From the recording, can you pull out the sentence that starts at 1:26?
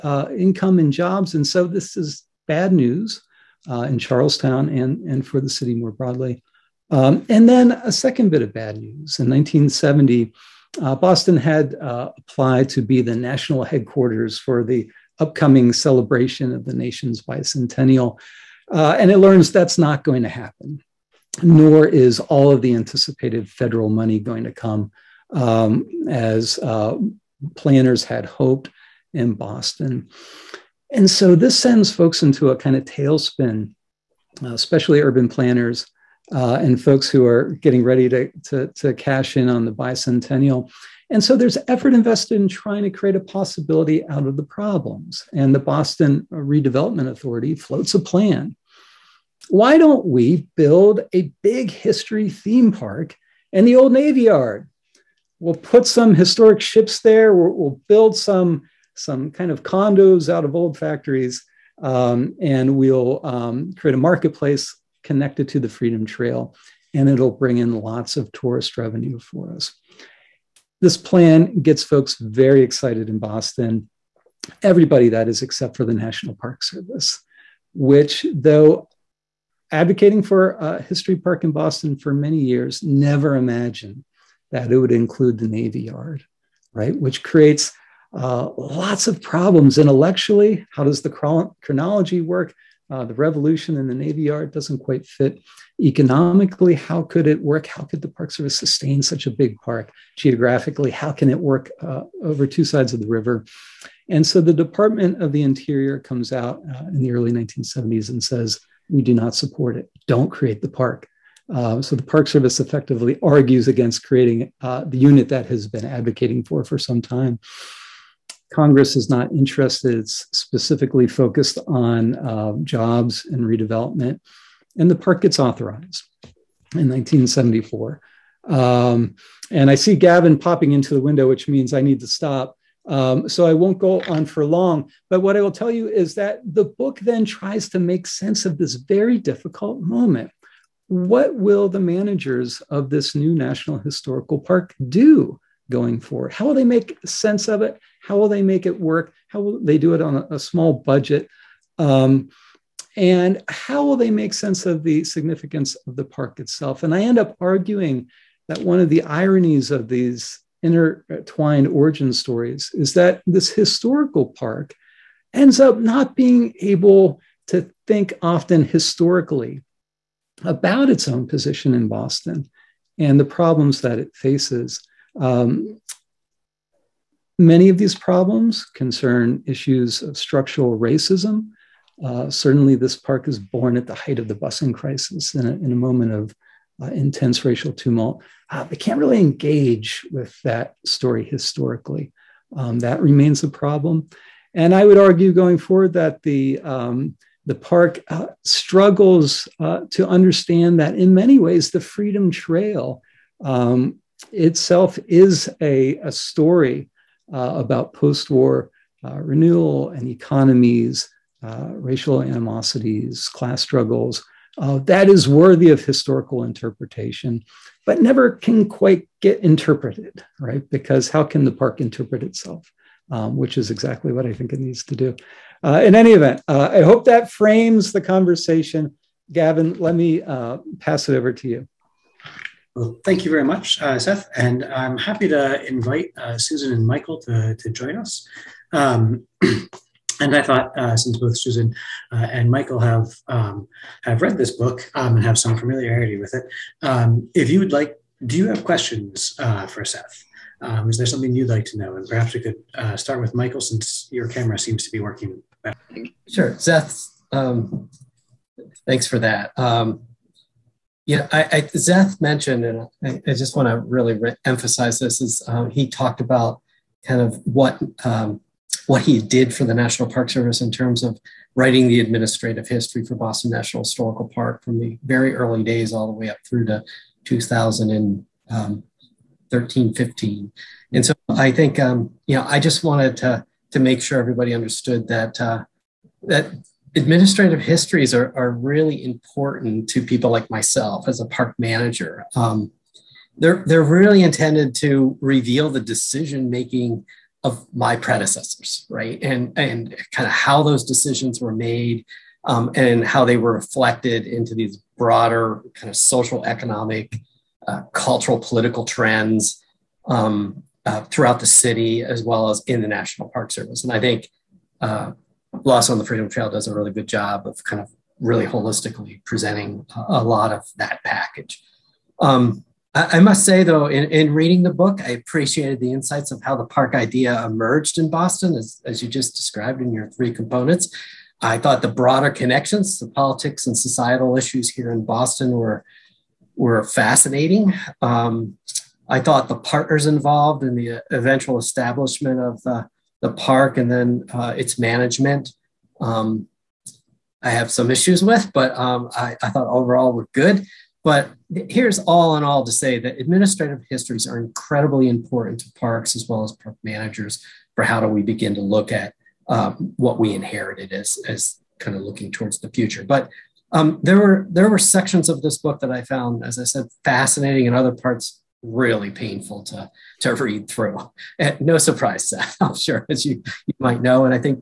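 Which creates uh, lots of problems intellectually.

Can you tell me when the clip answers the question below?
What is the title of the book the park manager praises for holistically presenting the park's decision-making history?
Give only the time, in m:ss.
5:15.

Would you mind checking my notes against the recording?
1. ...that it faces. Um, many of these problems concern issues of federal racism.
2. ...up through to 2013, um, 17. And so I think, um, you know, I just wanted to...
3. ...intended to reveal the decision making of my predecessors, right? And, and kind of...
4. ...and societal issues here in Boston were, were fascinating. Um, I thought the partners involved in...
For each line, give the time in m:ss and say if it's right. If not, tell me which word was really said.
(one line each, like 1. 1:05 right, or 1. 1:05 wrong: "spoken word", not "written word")
1. 2:53 wrong: "structural", not "federal"
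2. 4:36 wrong: "15", not "17"
3. 4:54 right
4. 5:33 right.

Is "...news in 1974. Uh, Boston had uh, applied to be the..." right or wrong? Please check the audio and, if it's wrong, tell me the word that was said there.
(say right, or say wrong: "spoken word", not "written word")
wrong: "1970", not "1974".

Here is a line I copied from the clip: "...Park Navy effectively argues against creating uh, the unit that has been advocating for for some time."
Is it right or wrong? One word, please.
wrong.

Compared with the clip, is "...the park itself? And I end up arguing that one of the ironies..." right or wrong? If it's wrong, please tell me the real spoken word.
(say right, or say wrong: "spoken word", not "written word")
right.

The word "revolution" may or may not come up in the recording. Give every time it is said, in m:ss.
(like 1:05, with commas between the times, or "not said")
1:33.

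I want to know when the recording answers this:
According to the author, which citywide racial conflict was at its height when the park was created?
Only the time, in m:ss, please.
3:04.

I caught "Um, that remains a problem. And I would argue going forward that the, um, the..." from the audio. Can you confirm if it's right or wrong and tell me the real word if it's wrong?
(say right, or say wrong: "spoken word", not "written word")
right.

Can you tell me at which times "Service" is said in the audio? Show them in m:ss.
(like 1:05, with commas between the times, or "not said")
1:16, 1:38, 1:52, 4:30, 5:13.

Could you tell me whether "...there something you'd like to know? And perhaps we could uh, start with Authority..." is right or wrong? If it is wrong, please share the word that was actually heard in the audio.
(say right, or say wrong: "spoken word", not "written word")
wrong: "Michael", not "Authority".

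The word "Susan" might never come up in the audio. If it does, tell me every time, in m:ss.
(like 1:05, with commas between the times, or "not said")
3:56, 4:01.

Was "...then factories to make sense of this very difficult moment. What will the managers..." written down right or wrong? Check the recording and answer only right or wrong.
wrong.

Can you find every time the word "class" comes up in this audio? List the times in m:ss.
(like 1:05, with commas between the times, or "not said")
3:33.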